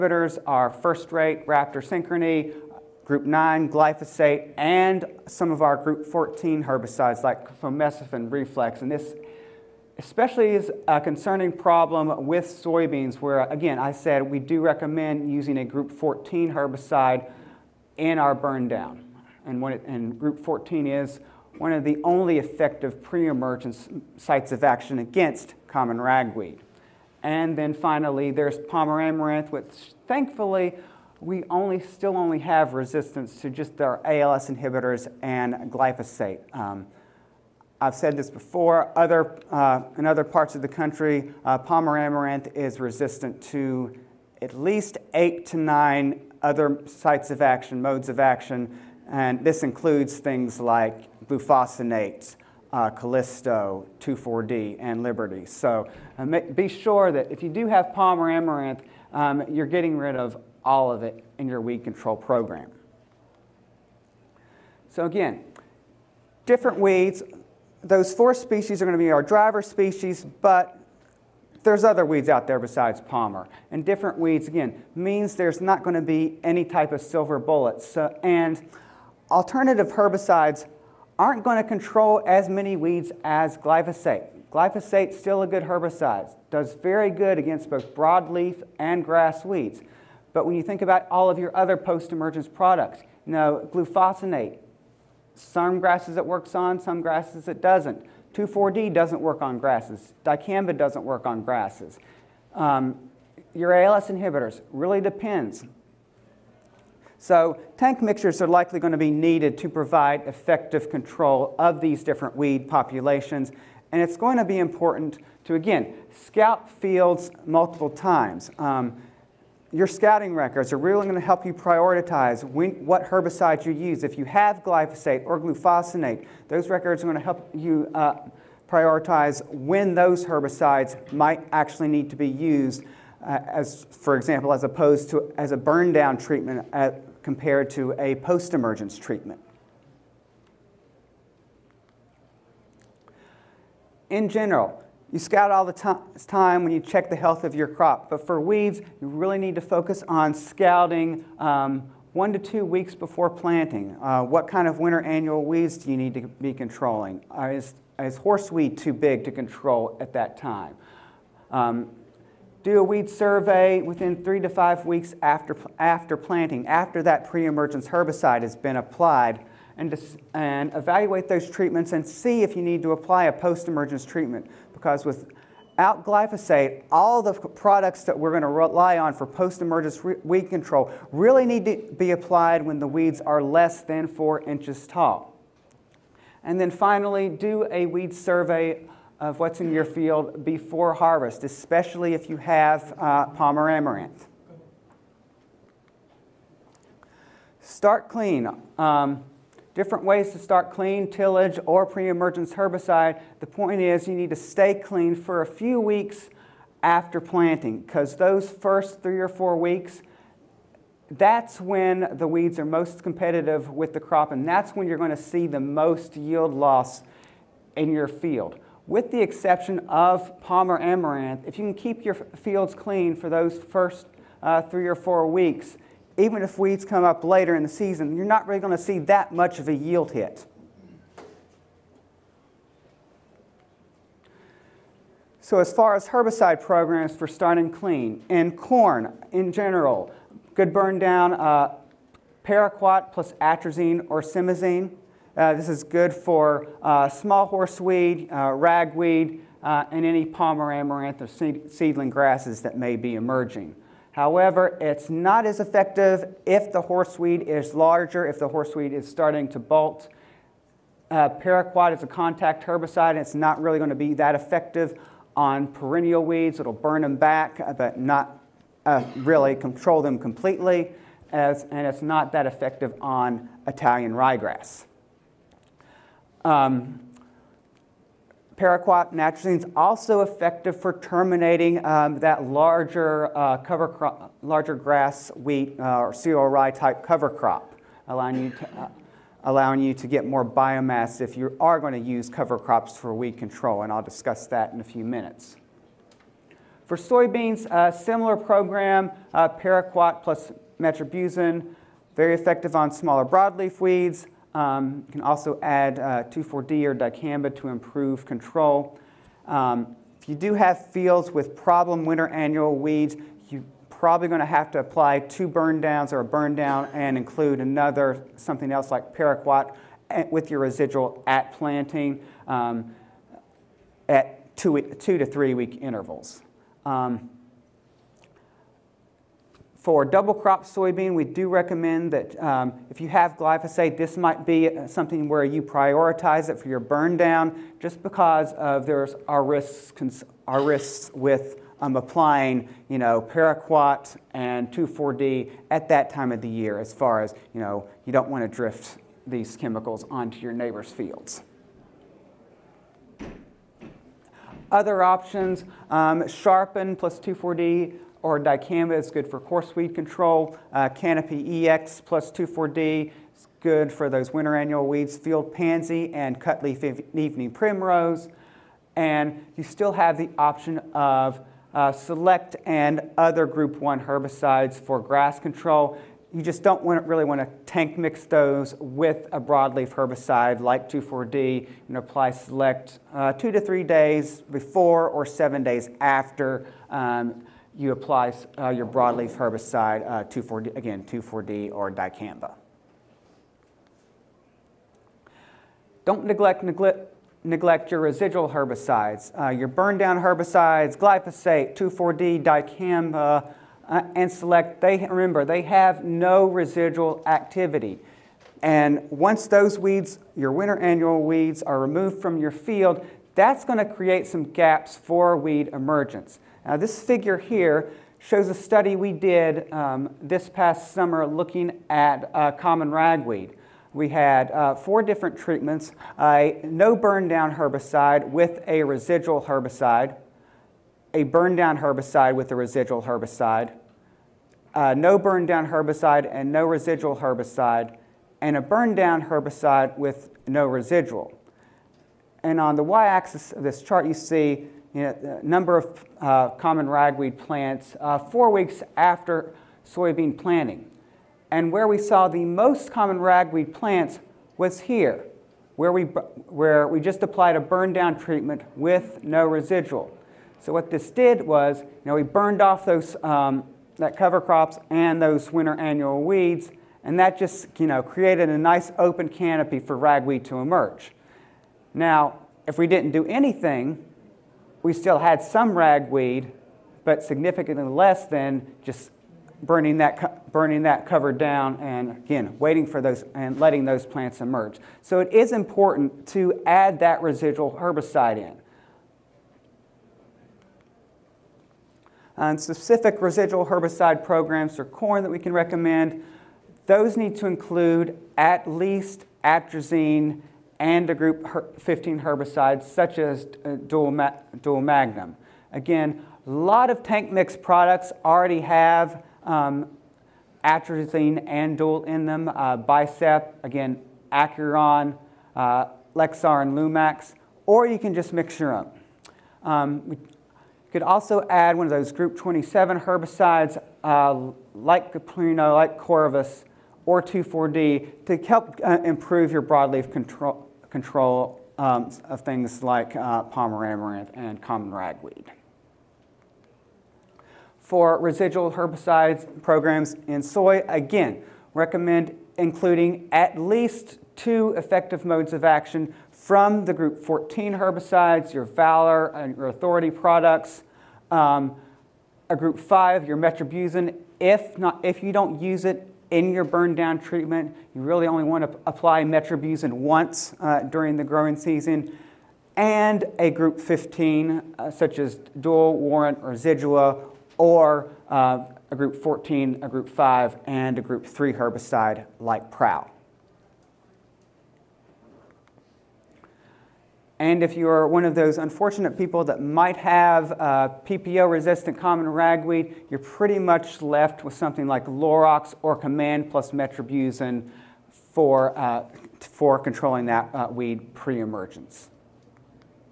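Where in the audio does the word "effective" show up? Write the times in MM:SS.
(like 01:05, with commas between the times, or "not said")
00:22, 01:50, 04:15, 04:24, 04:32, 04:40, 05:02, 09:04.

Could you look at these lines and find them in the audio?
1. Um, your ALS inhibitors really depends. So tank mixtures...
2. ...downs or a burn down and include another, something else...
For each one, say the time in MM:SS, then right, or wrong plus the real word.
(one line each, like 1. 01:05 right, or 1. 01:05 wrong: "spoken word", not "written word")
1. 01:42 right
2. 05:15 right.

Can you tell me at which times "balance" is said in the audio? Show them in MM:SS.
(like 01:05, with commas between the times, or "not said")
not said.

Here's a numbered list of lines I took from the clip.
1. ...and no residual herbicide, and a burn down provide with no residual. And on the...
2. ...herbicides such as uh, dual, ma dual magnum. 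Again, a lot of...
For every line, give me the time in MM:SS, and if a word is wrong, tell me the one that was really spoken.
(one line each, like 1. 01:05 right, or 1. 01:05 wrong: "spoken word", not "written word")
1. 07:16 wrong: "herbicide", not "provide"
2. 08:22 right.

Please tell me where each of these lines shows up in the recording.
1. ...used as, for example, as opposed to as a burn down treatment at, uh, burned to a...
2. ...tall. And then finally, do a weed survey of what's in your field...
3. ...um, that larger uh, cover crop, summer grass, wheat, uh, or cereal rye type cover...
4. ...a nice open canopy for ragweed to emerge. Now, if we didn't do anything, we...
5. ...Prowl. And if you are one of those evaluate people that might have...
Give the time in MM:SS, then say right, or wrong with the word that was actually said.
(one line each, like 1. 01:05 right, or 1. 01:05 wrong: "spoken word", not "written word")
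1. 02:12 wrong: "compared", not "burned"
2. 03:04 right
3. 04:41 wrong: "larger", not "summer"
4. 07:48 right
5. 09:32 wrong: "unfortunate", not "evaluate".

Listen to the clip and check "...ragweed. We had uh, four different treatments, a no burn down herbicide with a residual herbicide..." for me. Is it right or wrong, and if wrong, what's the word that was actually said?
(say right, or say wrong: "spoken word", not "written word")
right.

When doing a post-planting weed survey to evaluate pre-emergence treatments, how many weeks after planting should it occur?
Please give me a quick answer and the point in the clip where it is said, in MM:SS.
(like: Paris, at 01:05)
3 to 5 weeks, at 02:44.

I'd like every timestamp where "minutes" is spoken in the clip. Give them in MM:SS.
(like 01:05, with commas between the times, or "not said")
04:55.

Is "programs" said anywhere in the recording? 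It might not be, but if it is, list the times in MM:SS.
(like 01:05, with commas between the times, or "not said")
01:02, 03:56, 04:58, 08:14, 08:59.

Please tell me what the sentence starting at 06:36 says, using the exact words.
Don't neglect, neglect, neglect your residual herbicides, uh, your burn down herbicides, glyphosate, 2,4-D, dicamba, uh, and select.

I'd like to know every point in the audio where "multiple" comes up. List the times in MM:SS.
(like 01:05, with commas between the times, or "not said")
01:57.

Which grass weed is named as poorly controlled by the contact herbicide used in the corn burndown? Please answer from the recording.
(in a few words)
Italian ryegrass.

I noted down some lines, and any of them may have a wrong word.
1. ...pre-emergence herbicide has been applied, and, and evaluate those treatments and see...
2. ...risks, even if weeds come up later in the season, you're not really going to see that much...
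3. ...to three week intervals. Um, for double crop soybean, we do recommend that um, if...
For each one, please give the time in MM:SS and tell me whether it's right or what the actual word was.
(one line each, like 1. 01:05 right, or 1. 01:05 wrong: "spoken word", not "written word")
1. 02:47 right
2. 03:45 wrong: "weeks", not "risks"
3. 05:25 right.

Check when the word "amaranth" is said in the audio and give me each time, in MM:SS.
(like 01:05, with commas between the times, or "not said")
00:29, 00:41, 00:58, 03:13, 03:40, 04:10, 08:53.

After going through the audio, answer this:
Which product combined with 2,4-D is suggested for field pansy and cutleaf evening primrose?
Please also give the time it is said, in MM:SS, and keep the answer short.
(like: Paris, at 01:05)
Canopy EX, at 06:00.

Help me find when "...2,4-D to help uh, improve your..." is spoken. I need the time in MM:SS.
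08:47.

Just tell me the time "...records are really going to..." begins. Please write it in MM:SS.
02:00.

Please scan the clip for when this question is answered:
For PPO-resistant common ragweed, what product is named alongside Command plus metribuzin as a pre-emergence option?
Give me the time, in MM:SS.
09:45.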